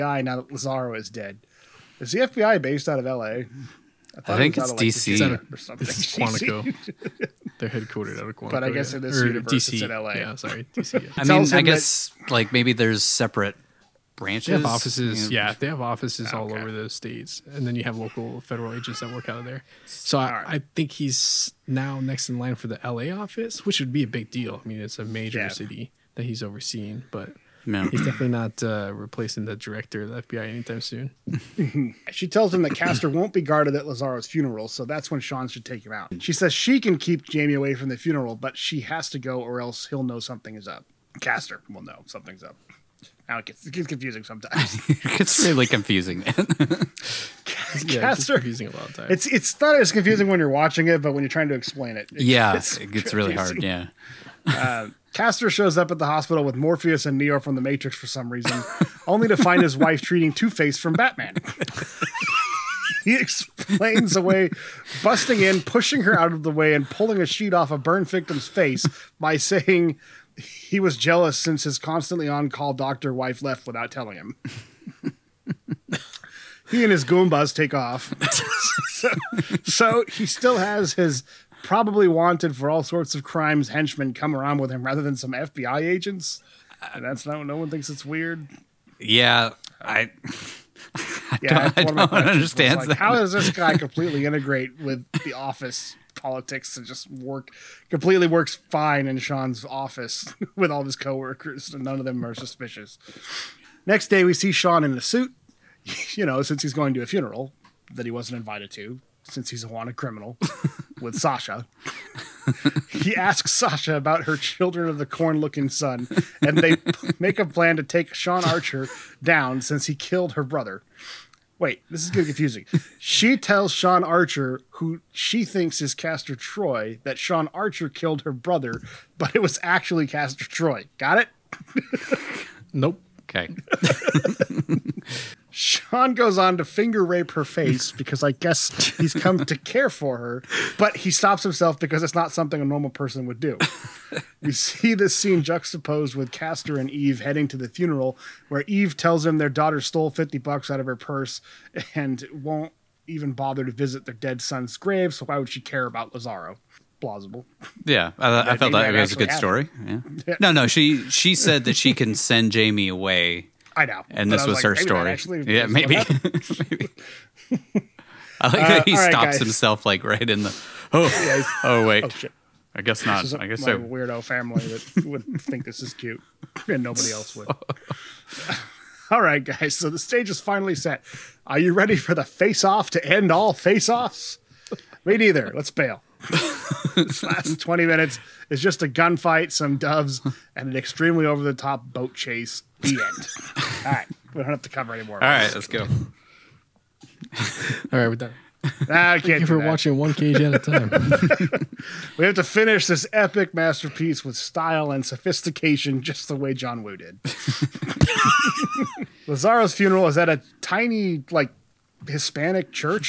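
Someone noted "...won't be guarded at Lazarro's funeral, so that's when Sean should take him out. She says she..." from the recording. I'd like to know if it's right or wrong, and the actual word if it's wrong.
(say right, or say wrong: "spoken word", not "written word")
right.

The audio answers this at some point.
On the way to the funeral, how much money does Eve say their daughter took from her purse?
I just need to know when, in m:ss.
2:30.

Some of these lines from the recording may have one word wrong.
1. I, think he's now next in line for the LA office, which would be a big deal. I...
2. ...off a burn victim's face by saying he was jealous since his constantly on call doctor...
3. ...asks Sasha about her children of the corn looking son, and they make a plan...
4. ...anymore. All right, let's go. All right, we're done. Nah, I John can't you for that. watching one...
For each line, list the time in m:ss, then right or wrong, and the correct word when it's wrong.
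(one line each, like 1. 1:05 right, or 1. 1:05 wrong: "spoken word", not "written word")
1. 0:20 right
2. 1:07 right
3. 1:53 right
4. 3:14 wrong: "Thank", not "John".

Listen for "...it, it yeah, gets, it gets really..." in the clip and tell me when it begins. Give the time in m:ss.
0:51.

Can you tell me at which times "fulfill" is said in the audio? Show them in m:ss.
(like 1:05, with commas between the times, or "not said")
not said.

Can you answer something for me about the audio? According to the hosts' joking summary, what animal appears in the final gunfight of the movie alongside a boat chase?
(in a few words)
doves.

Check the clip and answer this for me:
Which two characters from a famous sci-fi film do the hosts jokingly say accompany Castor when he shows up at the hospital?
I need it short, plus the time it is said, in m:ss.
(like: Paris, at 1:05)
Morpheus and Neo, at 0:56.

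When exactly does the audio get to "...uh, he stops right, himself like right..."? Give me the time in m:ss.
2:48.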